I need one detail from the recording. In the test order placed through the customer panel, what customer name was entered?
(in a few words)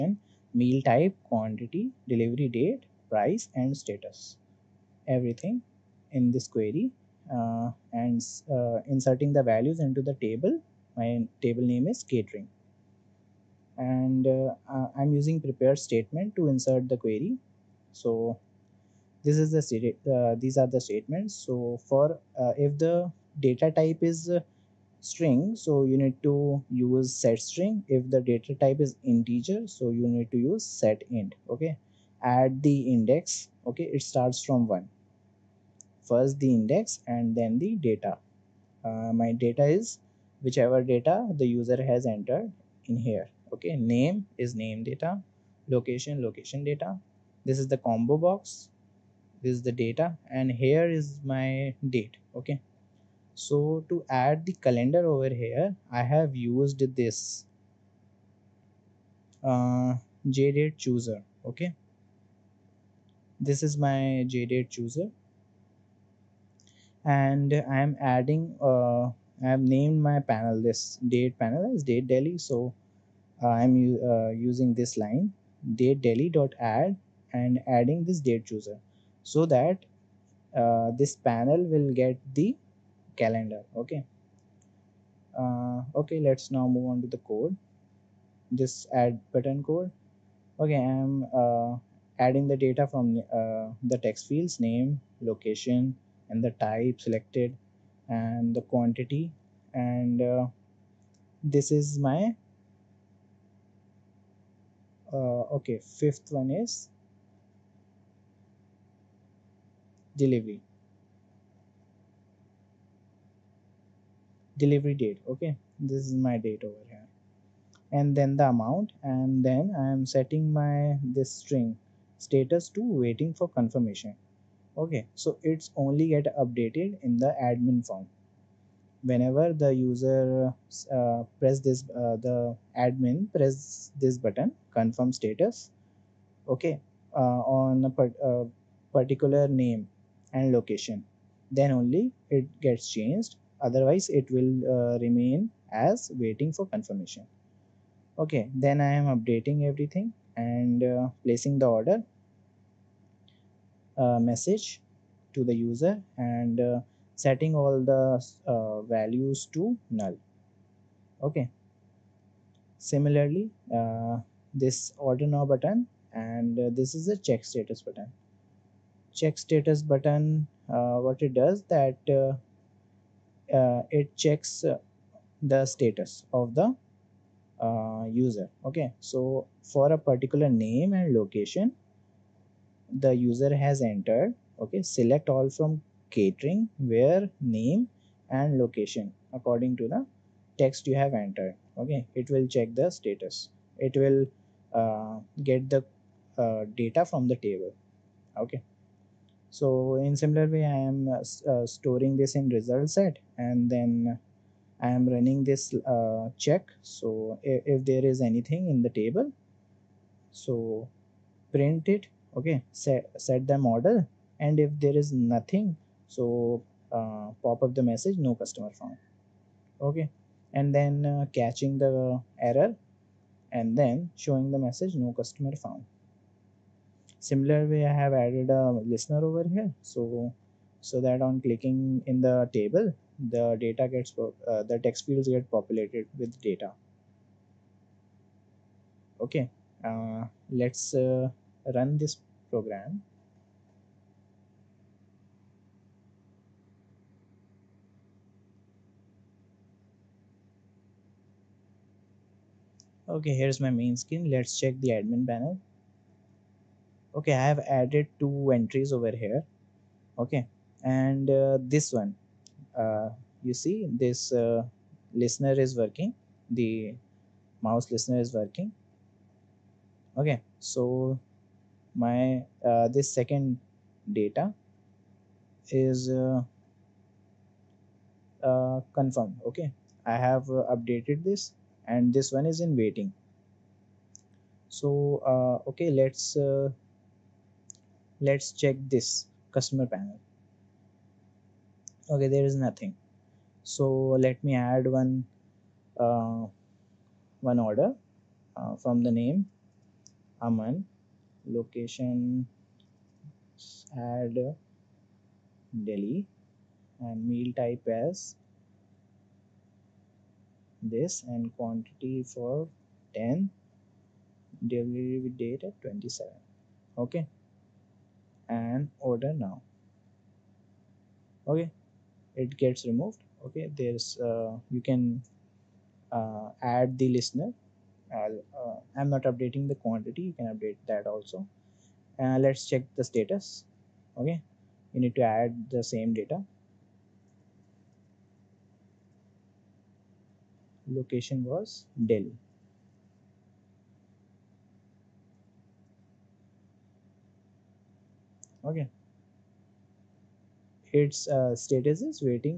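Aman.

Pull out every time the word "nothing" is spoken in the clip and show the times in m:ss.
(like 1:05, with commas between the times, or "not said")
3:35, 4:52.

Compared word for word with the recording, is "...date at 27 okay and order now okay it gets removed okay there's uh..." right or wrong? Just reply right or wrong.
right.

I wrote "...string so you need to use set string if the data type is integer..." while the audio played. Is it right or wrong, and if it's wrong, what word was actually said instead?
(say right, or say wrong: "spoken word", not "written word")
right.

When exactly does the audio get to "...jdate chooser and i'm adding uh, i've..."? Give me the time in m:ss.
1:04.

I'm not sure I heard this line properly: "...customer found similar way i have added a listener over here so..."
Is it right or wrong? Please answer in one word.
right.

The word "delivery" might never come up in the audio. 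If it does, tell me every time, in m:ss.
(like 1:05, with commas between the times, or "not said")
0:02, 1:50, 1:54, 5:14.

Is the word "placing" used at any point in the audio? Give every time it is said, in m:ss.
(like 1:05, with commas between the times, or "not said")
2:31.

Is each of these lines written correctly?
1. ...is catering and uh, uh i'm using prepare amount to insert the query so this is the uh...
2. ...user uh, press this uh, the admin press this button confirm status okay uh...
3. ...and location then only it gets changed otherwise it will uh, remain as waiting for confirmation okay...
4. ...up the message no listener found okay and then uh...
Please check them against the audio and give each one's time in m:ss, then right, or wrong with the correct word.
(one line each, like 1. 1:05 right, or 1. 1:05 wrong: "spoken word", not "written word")
1. 0:11 wrong: "statement", not "amount"
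2. 2:09 right
3. 2:20 right
4. 3:37 wrong: "customer", not "listener".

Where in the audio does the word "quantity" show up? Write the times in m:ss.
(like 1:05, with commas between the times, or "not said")
0:01, 1:38, 5:11, 5:29.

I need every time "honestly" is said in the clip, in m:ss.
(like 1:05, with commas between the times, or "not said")
not said.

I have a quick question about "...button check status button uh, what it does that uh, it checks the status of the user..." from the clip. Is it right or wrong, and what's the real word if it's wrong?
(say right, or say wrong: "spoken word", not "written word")
right.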